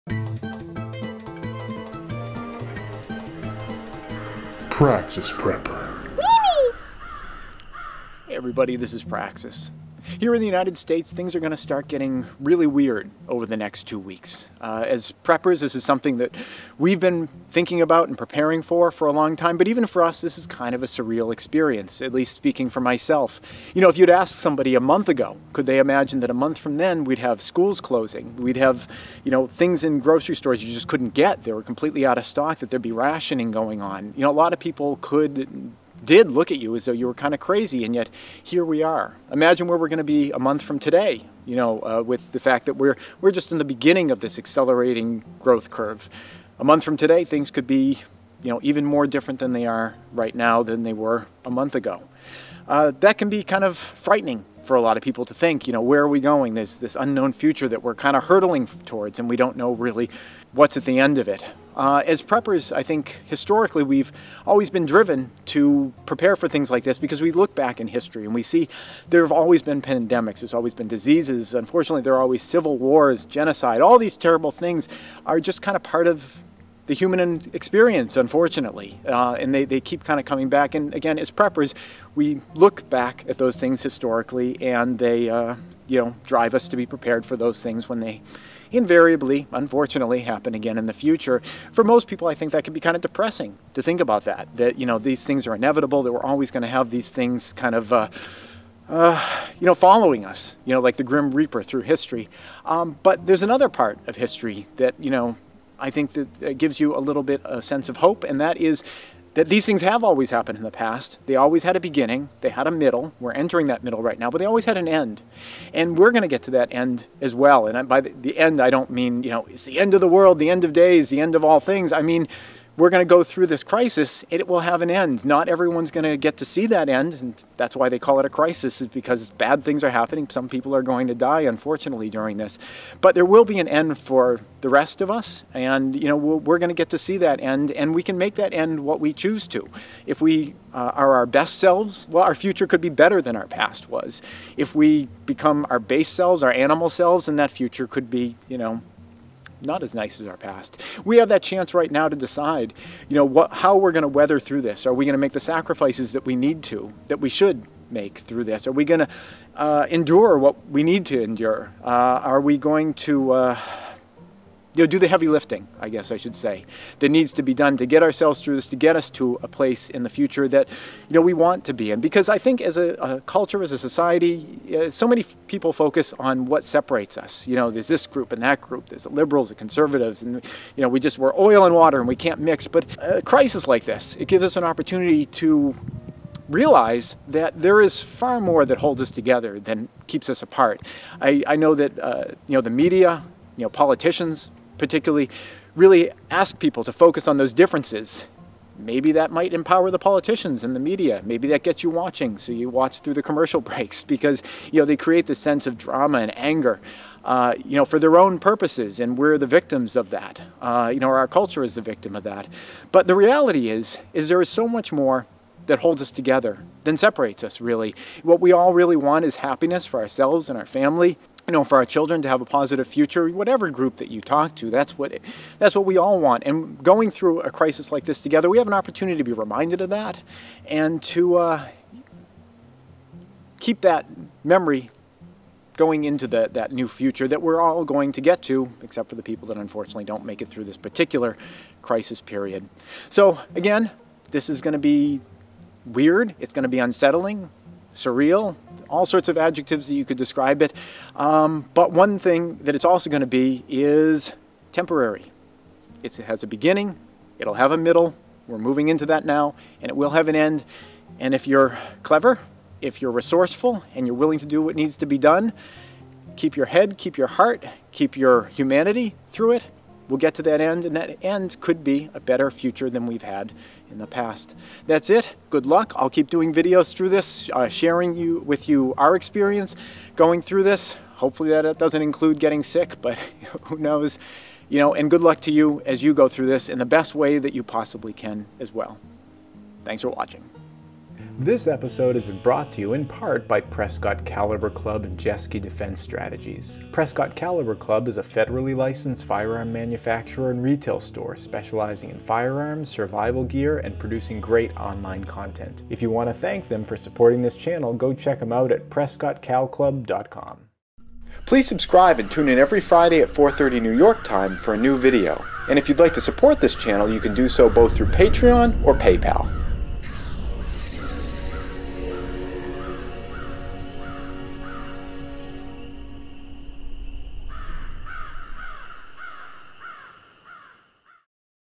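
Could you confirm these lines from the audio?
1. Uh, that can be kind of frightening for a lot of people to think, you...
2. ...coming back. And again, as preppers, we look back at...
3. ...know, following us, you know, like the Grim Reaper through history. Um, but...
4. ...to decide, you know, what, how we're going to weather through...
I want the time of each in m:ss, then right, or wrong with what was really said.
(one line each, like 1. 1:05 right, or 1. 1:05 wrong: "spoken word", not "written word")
1. 0:52 right
2. 1:20 right
3. 1:39 right
4. 2:32 right.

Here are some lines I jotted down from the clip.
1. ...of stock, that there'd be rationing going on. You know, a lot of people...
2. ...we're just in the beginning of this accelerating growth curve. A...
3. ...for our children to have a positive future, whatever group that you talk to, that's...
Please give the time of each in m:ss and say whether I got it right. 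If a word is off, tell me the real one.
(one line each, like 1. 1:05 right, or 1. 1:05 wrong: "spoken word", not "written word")
1. 0:32 right
2. 0:43 right
3. 3:41 right.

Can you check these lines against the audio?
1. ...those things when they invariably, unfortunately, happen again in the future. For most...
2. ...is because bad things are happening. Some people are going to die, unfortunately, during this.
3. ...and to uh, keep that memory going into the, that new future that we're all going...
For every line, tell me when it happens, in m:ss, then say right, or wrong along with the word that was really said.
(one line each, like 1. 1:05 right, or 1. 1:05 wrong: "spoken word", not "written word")
1. 1:27 right
2. 2:08 right
3. 3:50 right.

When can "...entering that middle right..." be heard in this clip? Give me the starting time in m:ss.
1:53.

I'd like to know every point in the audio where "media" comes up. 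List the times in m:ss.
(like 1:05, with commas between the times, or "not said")
3:12, 3:20.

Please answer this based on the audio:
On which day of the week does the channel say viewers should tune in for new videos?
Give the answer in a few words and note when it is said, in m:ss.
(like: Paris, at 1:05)
Friday, at 5:12.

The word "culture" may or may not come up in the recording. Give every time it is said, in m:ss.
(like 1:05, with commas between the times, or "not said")
2:53, 3:31.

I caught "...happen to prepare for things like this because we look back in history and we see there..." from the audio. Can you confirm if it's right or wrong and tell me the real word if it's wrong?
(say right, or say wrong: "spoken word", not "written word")
wrong: "driven", not "happen".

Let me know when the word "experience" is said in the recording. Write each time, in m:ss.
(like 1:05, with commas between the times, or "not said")
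0:21, 1:17, 4:39.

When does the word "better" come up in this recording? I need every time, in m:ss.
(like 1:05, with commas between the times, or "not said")
2:22, 4:32.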